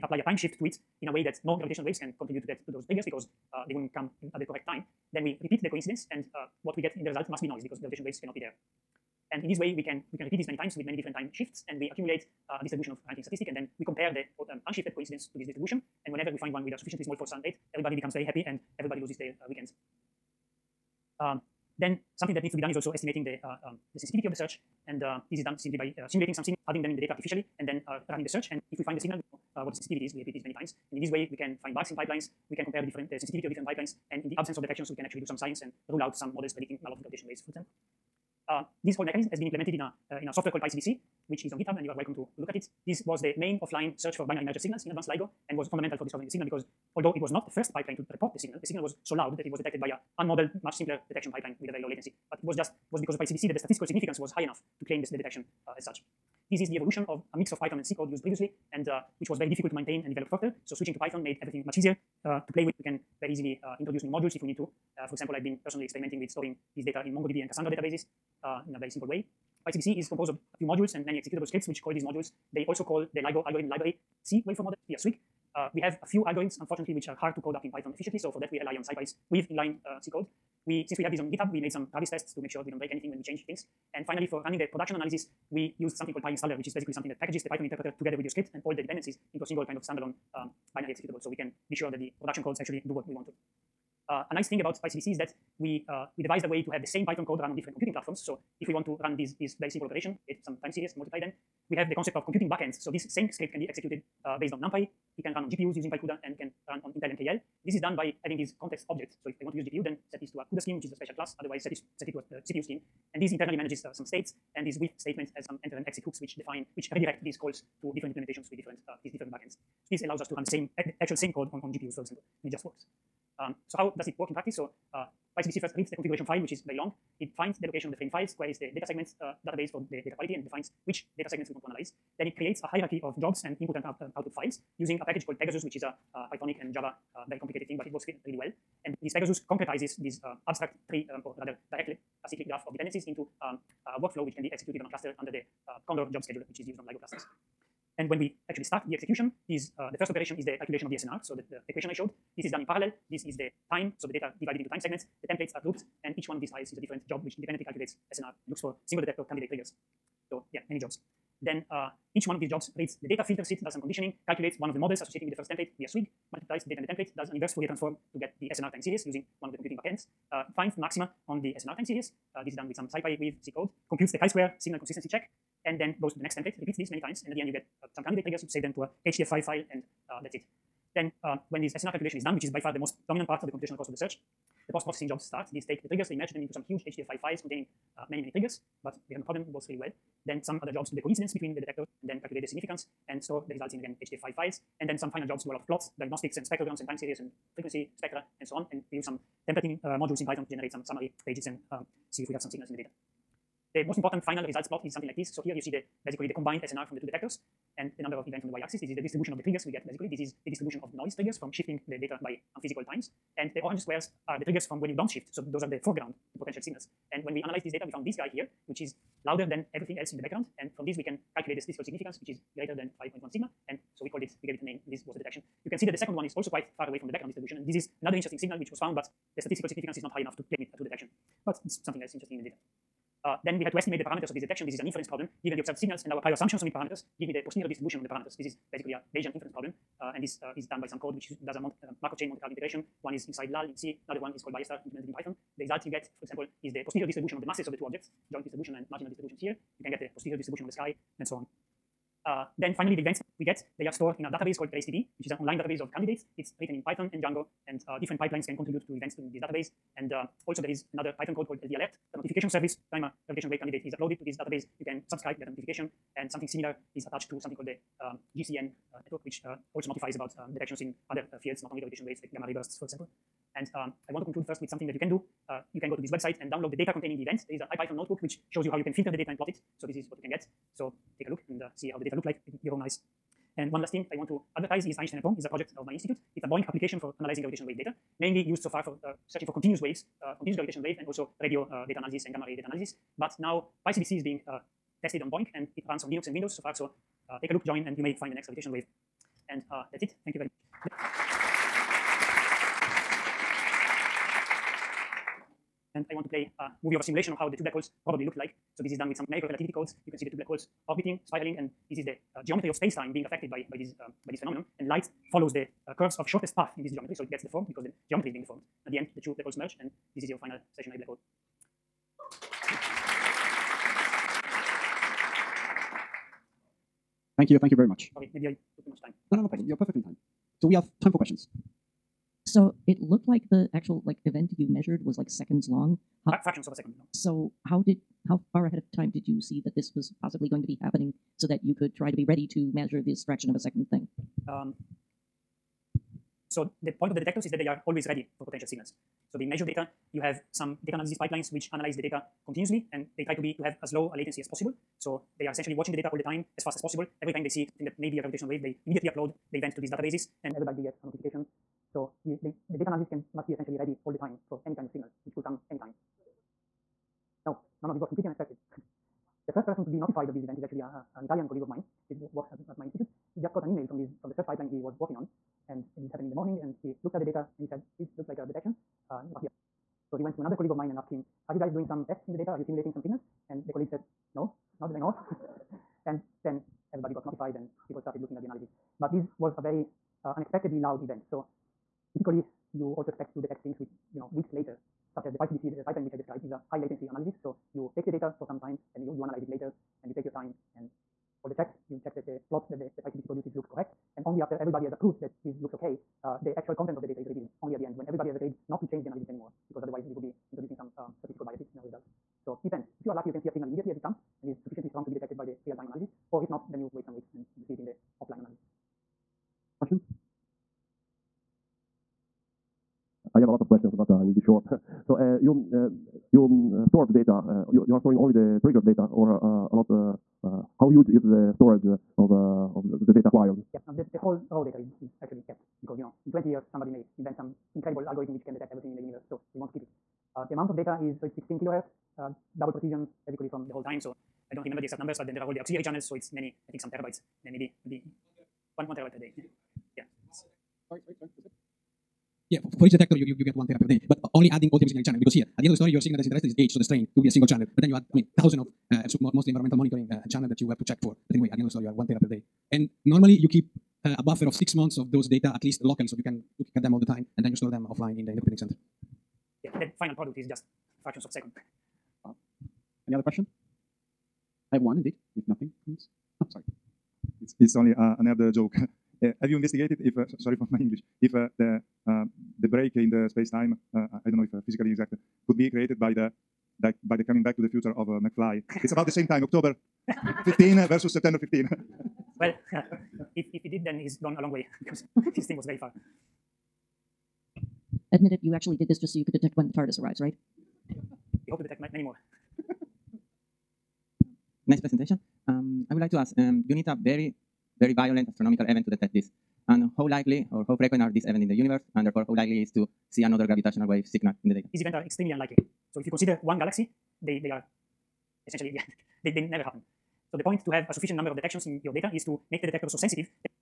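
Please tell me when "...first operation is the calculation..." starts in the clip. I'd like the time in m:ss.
2:29.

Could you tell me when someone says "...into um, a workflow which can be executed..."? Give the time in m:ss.
2:23.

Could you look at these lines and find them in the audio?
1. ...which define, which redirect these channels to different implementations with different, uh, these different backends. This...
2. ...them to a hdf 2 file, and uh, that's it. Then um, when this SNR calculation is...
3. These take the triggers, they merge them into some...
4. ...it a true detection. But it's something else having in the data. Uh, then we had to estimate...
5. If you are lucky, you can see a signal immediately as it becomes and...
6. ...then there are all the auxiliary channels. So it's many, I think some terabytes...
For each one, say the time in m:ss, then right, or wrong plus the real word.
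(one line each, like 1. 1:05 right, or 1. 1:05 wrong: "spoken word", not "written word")
1. 1:56 wrong: "calls", not "channels"
2. 2:58 wrong: "5", not "2"
3. 3:05 right
4. 3:50 wrong: "interesting", not "having"
5. 6:53 wrong: "comes", not "becomes"
6. 7:25 right.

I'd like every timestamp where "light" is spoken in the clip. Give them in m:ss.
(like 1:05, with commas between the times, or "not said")
5:14.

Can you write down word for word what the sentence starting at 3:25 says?
So here you see the basically the combined SNR from the two detectors and the number of events on the y-axis.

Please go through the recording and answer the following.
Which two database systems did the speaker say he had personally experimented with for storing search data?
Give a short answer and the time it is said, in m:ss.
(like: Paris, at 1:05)
MongoDB and Cassandra, at 1:07.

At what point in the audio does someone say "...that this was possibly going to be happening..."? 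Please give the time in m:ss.
5:39.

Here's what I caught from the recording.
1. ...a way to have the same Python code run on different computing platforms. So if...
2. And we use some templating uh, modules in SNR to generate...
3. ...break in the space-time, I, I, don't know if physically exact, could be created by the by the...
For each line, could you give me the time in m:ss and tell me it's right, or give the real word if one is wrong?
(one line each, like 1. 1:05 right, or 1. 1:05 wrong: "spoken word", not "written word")
1. 1:36 right
2. 3:18 wrong: "Python", not "SNR"
3. 8:02 right.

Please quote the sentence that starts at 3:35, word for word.
So those are the foreground, the potential signals.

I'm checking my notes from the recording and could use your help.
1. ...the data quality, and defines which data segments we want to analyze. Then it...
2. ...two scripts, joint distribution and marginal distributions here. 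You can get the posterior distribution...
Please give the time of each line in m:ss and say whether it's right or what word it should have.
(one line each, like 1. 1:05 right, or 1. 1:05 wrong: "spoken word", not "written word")
1. 2:09 right
2. 4:07 wrong: "objects", not "scripts".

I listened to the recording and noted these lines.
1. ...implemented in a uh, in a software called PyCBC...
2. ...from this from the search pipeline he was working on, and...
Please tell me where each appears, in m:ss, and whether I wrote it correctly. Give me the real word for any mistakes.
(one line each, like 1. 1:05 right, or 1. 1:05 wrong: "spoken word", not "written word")
1. 0:39 right
2. 6:13 right.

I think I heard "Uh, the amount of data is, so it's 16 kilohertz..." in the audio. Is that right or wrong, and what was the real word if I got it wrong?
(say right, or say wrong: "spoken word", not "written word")
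right.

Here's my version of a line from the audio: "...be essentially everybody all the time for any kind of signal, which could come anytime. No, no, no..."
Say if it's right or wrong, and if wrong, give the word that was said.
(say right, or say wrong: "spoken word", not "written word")
wrong: "ready", not "everybody".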